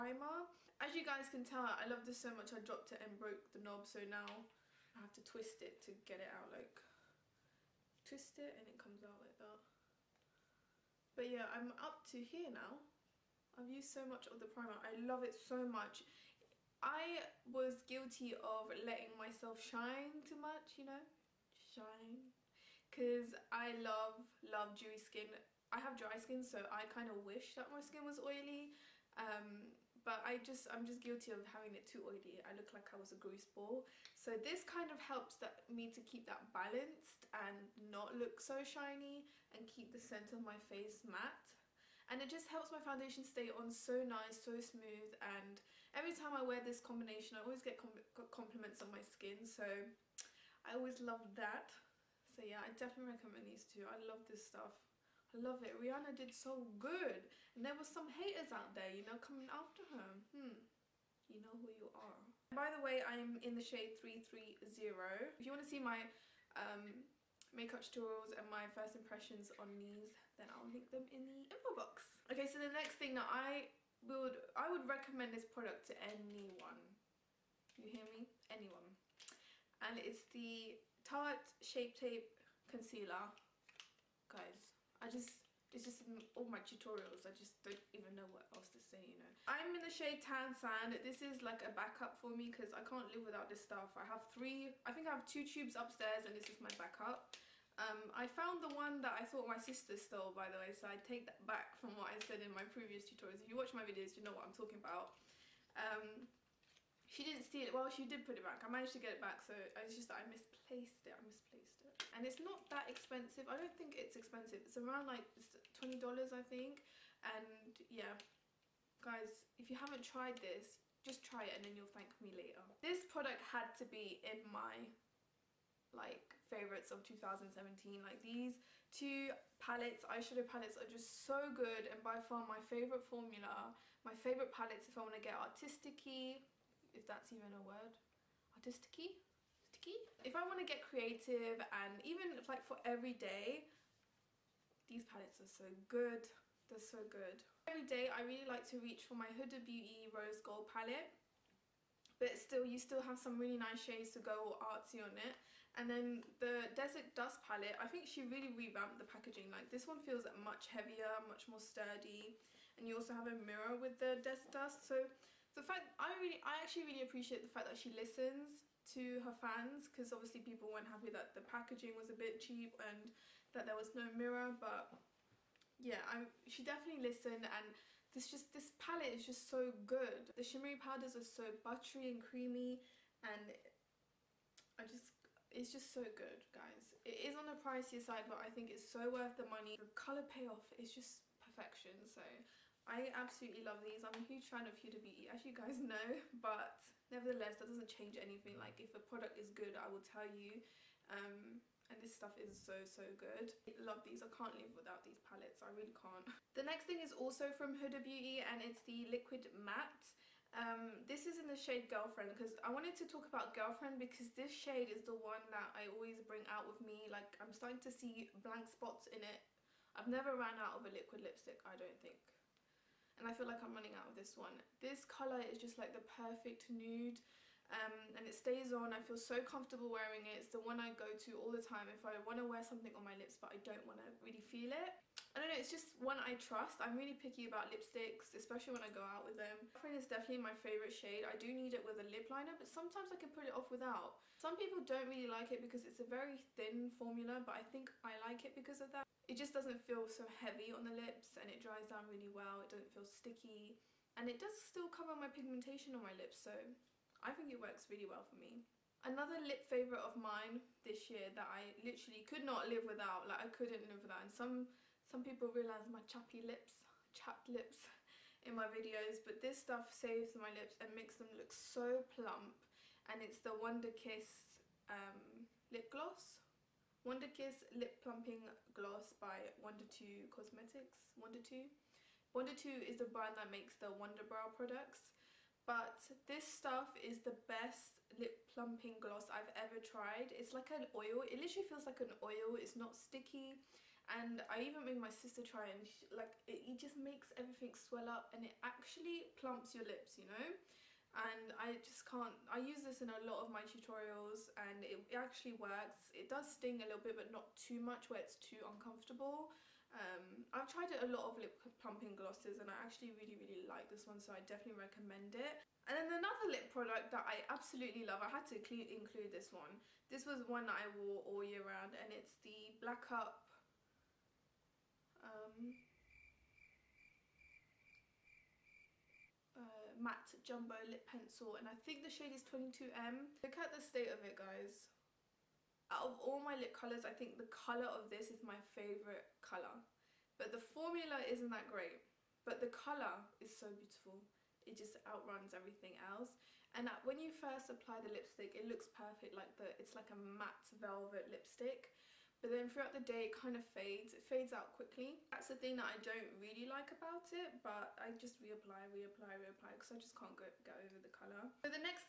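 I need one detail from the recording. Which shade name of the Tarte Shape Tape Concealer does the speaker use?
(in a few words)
Tan Sand.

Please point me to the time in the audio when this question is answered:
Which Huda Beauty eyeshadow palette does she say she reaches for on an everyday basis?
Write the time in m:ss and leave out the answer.
2:30.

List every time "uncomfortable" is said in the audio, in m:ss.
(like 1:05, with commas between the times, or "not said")
5:08.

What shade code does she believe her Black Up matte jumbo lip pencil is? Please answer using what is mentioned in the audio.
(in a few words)
22M.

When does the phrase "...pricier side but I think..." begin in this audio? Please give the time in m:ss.
3:07.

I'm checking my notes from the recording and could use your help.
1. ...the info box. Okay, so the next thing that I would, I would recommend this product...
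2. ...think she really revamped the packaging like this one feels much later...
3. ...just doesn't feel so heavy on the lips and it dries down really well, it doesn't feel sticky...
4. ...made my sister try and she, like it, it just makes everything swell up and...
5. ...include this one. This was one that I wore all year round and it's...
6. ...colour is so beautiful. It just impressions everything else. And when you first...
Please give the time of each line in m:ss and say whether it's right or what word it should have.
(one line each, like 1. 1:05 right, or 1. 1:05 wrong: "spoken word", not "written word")
1. 1:11 right
2. 2:37 wrong: "heavier", not "later"
3. 4:09 right
4. 4:54 right
5. 5:18 right
6. 5:42 wrong: "outruns", not "impressions".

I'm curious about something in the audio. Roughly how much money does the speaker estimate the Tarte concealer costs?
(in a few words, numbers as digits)
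$20.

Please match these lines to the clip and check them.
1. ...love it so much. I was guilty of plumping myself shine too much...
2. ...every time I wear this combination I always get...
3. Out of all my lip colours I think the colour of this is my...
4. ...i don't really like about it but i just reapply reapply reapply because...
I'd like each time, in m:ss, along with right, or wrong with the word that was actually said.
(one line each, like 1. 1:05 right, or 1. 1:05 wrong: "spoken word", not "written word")
1. 0:14 wrong: "letting", not "plumping"
2. 0:45 right
3. 5:35 right
4. 5:55 right.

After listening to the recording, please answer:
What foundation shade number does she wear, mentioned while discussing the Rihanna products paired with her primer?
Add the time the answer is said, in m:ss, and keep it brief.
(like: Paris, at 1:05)
330, at 1:03.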